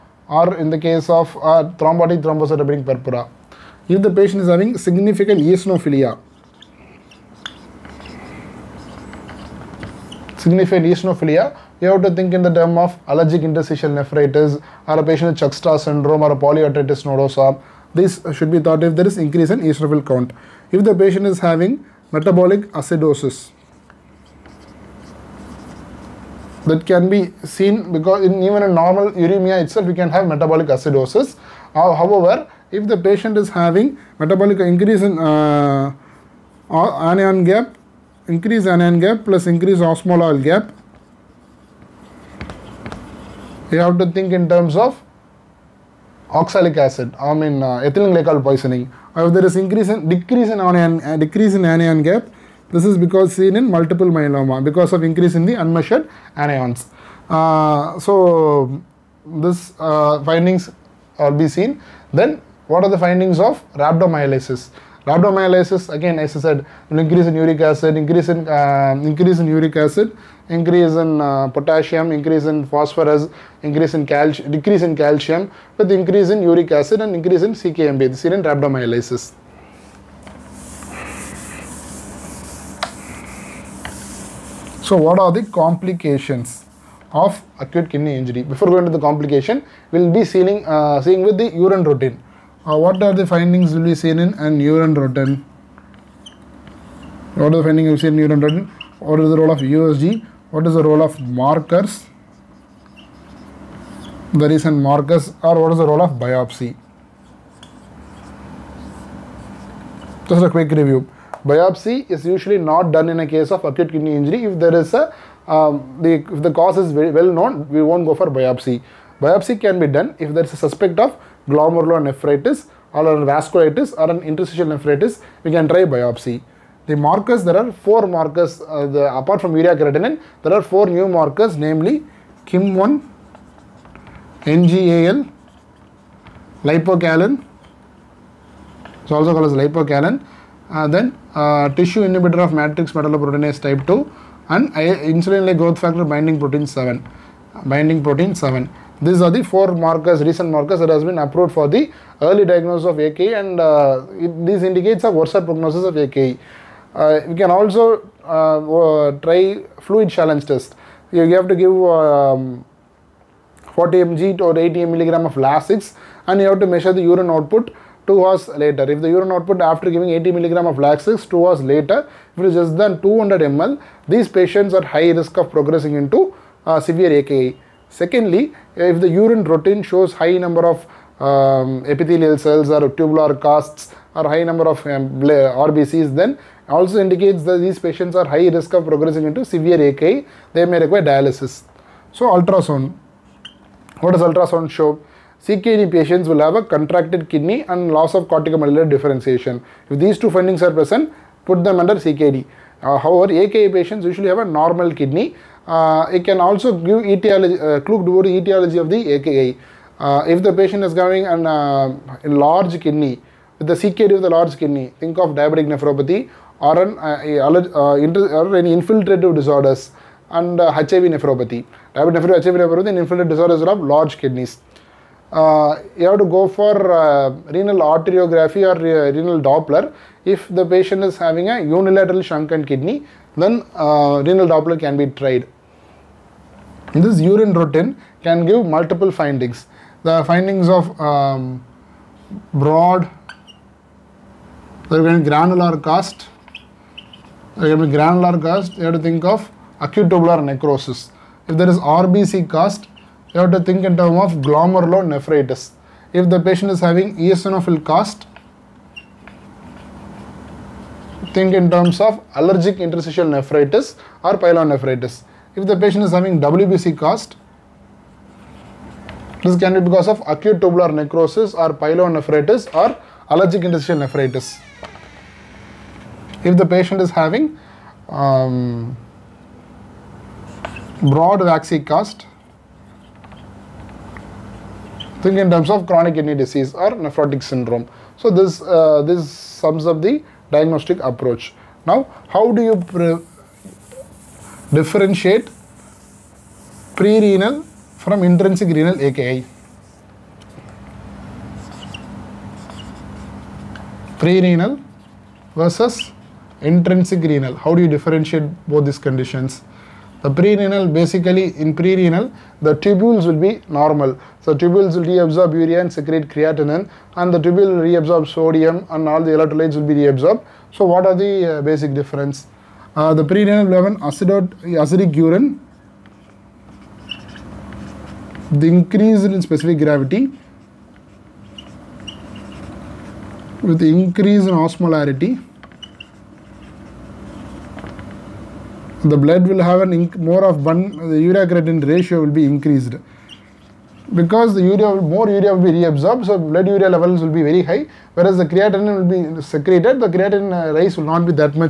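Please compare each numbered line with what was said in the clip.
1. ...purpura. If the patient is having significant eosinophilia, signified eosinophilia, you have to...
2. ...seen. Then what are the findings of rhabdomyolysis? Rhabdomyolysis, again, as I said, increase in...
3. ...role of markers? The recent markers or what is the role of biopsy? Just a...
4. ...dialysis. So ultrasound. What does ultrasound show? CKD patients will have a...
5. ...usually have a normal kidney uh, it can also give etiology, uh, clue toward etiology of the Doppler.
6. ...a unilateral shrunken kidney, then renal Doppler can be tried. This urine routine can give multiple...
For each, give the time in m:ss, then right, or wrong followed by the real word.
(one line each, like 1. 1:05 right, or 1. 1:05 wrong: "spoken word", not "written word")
1. 0:02 right
2. 1:01 right
3. 1:40 right
4. 3:11 right
5. 3:24 wrong: "AKI", not "Doppler"
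6. 3:51 right.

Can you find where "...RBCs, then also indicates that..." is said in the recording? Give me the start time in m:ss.
3:05.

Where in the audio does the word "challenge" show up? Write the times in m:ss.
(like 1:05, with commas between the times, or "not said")
2:40.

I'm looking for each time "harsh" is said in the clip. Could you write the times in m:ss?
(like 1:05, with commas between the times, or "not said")
not said.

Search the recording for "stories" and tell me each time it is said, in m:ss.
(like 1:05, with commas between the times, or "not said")
not said.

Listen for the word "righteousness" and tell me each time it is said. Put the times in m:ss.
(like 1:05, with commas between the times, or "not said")
not said.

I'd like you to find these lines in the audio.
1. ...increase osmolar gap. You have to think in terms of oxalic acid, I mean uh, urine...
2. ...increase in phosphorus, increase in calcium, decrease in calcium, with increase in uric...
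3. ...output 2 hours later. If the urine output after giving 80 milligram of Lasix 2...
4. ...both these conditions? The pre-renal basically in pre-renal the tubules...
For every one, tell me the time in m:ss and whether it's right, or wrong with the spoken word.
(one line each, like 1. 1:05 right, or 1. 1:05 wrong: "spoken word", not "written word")
1. 0:39 wrong: "ethylene", not "urine"
2. 1:12 right
3. 2:47 right
4. 5:08 right.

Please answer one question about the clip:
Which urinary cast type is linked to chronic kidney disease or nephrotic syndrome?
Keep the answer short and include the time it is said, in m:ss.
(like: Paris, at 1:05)
broad waxy cast, at 4:41.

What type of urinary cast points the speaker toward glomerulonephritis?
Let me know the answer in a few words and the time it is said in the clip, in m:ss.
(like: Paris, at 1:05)
RBC cast, at 4:11.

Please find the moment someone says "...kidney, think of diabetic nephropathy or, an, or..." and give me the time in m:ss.
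3:34.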